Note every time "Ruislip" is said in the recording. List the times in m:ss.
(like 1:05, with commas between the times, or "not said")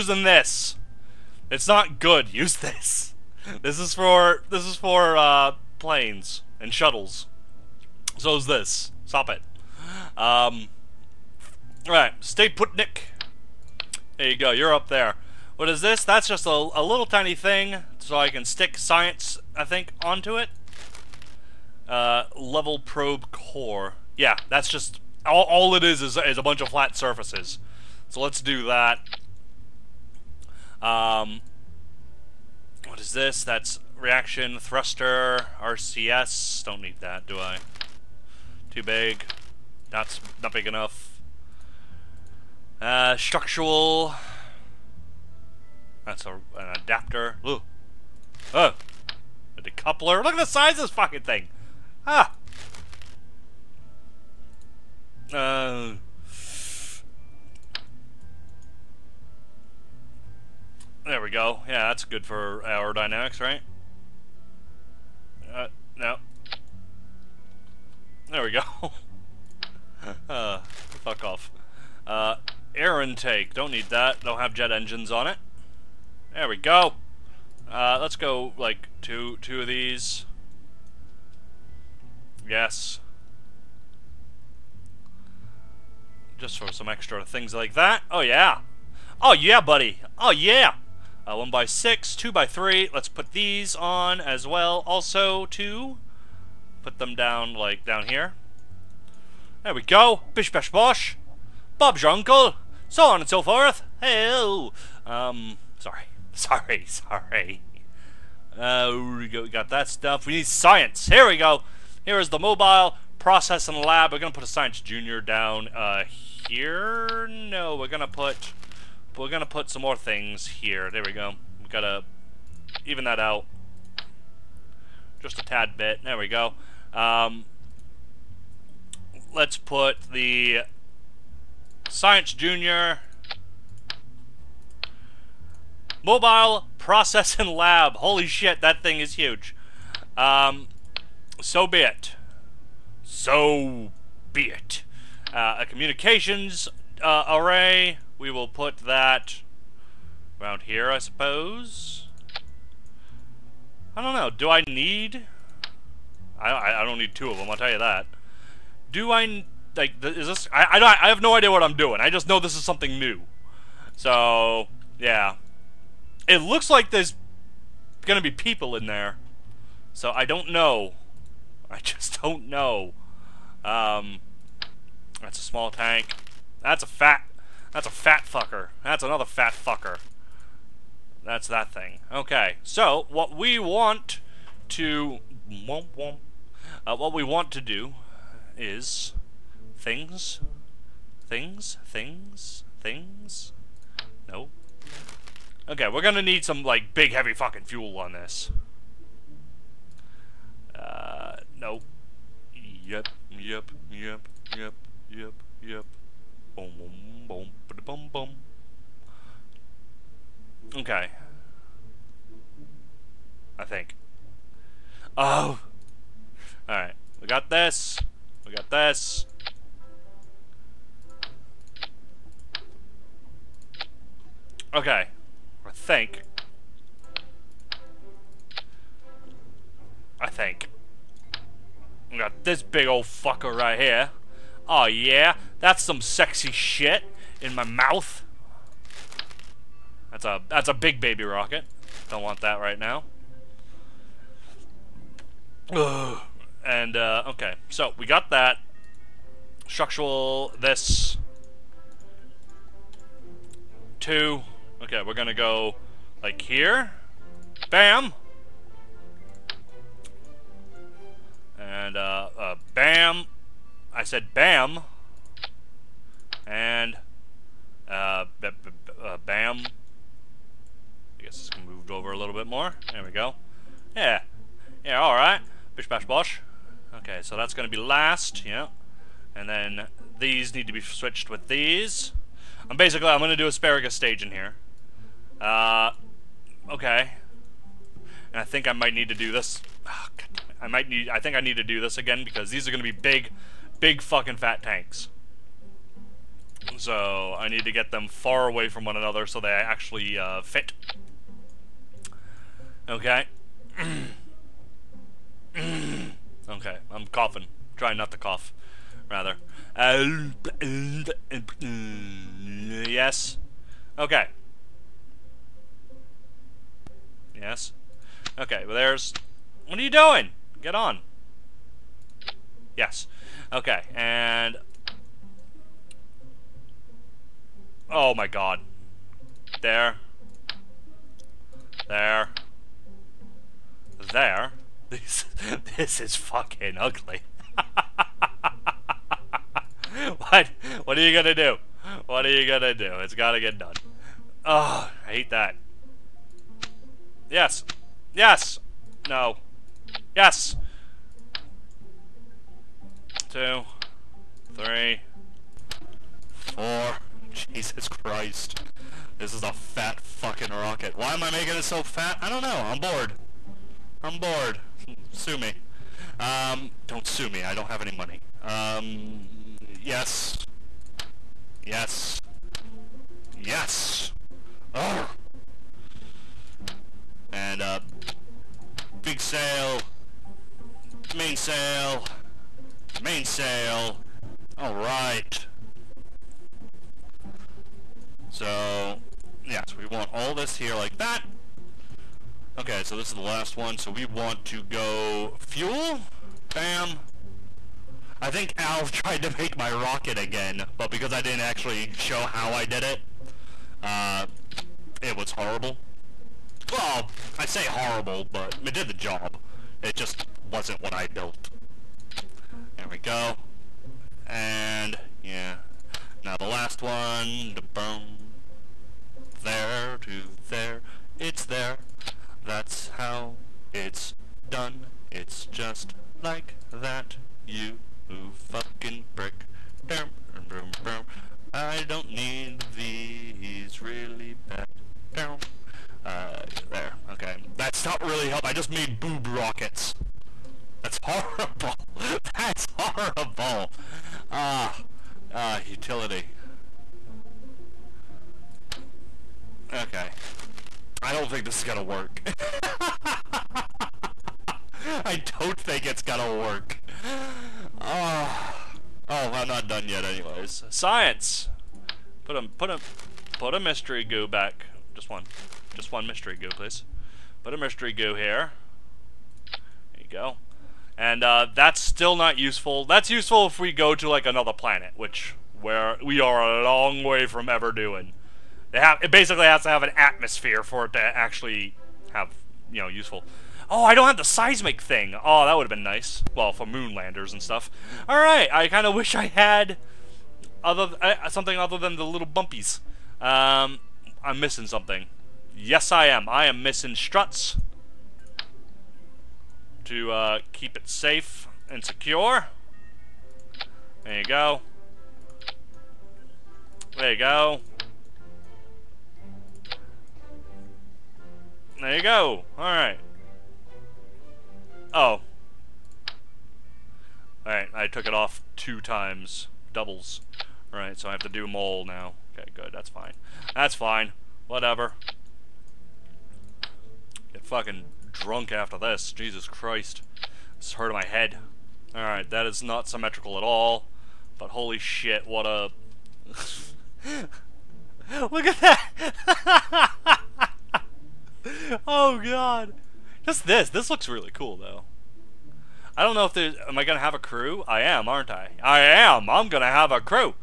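not said.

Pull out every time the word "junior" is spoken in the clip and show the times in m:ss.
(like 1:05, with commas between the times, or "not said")
1:54, 2:12.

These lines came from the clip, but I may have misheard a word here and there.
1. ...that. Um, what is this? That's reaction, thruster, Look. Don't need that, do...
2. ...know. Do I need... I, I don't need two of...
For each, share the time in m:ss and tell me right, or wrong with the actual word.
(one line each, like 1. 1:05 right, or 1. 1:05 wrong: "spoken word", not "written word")
1. 0:28 wrong: "RCS", not "Look"
2. 2:34 right.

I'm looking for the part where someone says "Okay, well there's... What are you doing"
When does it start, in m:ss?
5:18.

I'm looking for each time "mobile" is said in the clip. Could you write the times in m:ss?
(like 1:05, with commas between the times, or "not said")
1:52, 2:16.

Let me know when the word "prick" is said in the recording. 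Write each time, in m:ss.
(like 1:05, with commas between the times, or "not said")
7:09.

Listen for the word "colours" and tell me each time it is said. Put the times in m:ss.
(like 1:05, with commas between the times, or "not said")
not said.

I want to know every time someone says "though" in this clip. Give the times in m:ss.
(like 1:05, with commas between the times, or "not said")
9:04.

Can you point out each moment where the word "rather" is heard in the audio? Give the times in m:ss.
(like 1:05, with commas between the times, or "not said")
5:09.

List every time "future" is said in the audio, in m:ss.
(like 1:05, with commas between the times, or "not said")
not said.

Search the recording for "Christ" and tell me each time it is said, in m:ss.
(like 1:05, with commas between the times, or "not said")
5:57, 8:49.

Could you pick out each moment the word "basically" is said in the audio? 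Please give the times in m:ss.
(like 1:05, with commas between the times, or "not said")
4:42, 7:59.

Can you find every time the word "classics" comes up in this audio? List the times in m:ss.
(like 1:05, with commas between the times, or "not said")
not said.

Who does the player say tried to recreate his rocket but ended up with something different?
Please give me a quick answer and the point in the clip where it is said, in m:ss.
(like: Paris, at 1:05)
Al, at 6:38.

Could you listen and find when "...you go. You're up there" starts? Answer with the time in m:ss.
0:14.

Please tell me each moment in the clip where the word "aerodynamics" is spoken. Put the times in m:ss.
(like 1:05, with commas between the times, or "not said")
1:02.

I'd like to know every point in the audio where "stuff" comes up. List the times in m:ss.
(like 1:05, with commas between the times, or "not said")
1:49, 8:07.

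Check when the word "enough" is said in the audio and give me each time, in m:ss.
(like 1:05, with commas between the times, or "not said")
0:40.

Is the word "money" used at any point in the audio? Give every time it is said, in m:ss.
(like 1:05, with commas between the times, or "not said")
6:07.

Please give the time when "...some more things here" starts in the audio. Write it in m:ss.
1:59.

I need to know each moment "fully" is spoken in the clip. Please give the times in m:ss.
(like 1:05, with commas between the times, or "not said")
not said.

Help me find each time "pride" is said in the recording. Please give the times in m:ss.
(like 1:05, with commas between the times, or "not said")
not said.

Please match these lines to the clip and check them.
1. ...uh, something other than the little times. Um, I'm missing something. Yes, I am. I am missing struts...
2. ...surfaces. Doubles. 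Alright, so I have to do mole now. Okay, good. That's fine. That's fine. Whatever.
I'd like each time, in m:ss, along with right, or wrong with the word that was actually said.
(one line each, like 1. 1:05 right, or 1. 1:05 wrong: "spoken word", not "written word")
1. 8:11 wrong: "bumpies", not "times"
2. 8:38 wrong: "times", not "surfaces".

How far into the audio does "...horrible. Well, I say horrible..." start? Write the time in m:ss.
6:45.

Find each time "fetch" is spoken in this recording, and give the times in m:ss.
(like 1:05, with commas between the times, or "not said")
not said.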